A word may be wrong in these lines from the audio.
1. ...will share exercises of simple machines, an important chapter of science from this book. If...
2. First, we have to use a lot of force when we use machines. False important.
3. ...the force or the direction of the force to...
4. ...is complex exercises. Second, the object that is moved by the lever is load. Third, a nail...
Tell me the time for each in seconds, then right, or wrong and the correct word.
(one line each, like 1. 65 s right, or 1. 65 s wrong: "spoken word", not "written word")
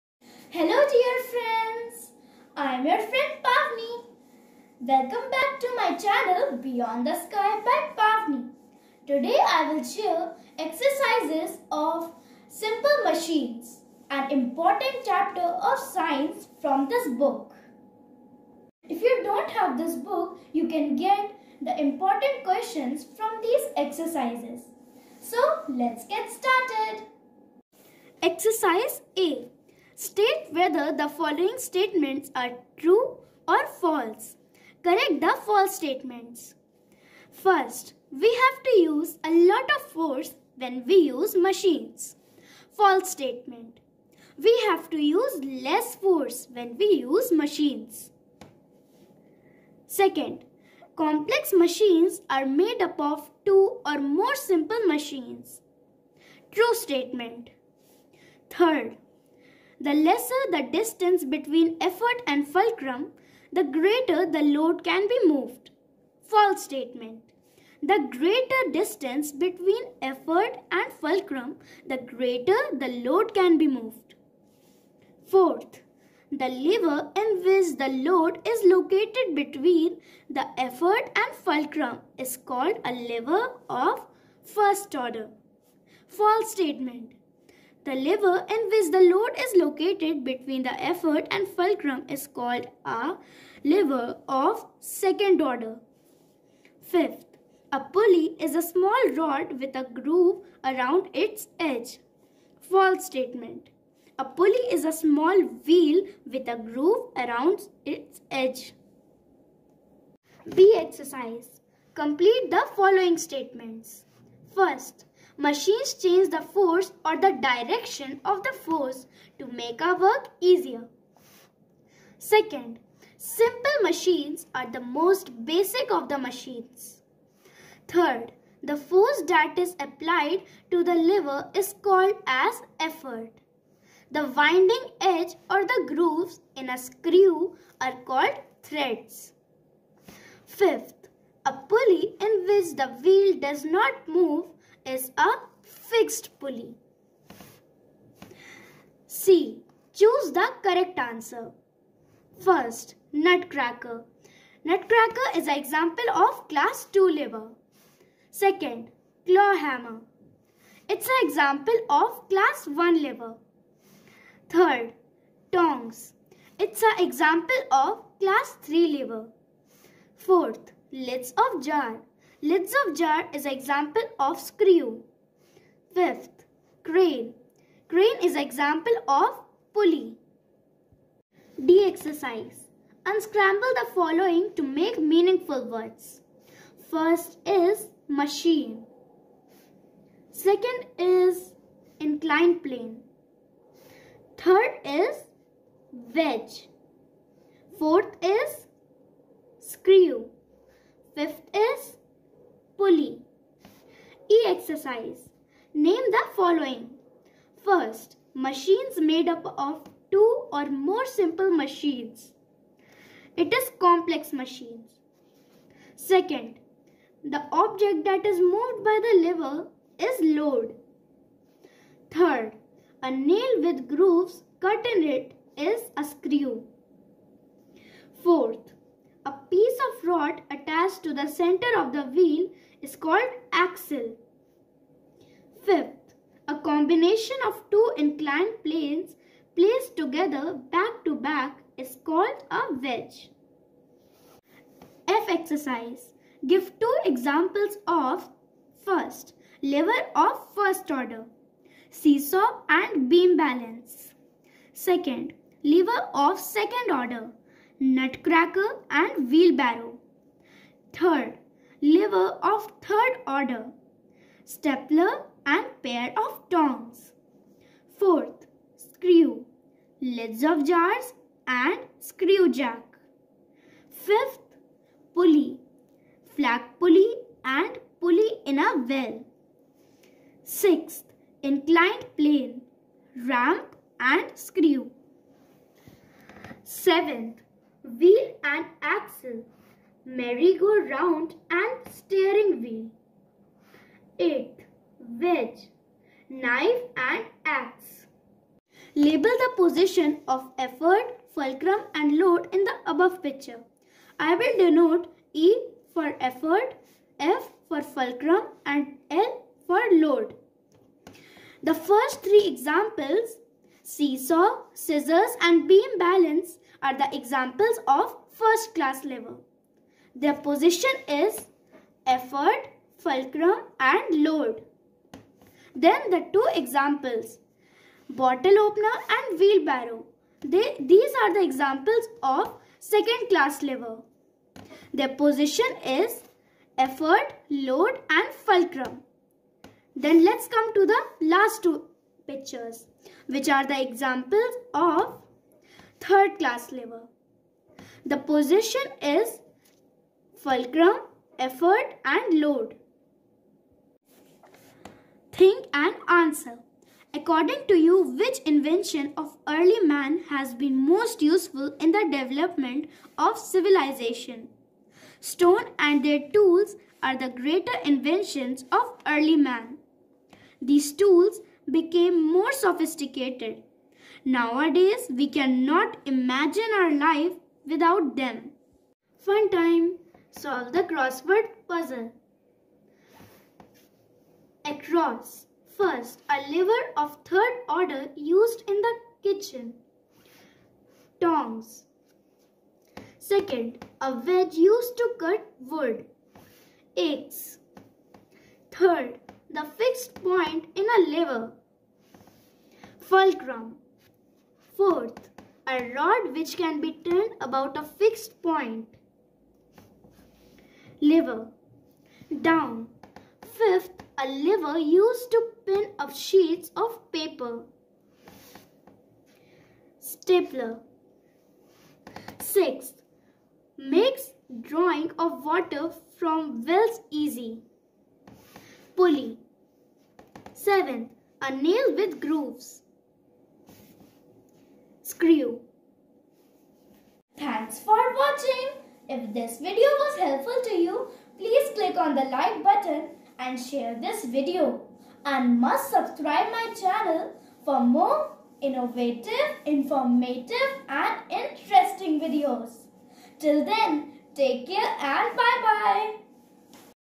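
1. 9 s right
2. 37 s wrong: "statement", not "important"
3. 116 s right
4. 213 s wrong: "machines", not "exercises".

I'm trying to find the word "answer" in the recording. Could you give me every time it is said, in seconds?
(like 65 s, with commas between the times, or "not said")
150 s, 356 s.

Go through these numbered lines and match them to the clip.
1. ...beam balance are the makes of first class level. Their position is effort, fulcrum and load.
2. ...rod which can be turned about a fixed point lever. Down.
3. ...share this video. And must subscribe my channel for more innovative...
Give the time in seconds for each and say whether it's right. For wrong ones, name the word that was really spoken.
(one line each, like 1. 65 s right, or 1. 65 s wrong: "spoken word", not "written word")
1. 315 s wrong: "examples", not "makes"
2. 405 s right
3. 443 s right.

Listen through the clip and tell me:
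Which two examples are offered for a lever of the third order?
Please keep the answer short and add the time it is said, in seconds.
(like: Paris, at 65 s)
Stapler and pair of tongs, at 264 s.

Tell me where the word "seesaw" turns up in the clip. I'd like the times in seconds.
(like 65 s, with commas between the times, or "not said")
251 s, 313 s.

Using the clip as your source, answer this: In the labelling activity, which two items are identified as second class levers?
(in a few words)
Bottle opener and wheelbarrow.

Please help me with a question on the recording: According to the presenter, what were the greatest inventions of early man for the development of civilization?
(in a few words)
Stone and their tools.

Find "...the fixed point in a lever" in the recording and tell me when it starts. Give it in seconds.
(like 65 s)
399 s.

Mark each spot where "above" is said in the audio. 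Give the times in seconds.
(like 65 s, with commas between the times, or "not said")
302 s.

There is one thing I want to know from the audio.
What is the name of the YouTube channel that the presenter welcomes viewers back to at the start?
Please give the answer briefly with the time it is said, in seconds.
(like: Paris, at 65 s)
Beyond the Sky by Pavani, at 6 s.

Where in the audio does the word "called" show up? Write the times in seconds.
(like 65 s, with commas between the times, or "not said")
82 s, 92 s, 131 s, 138 s, 232 s, 242 s.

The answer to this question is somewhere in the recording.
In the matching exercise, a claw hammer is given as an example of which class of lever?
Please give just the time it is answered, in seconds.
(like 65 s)
162 s.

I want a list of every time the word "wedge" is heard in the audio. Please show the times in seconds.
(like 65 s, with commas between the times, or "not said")
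196 s, 242 s, 295 s, 394 s.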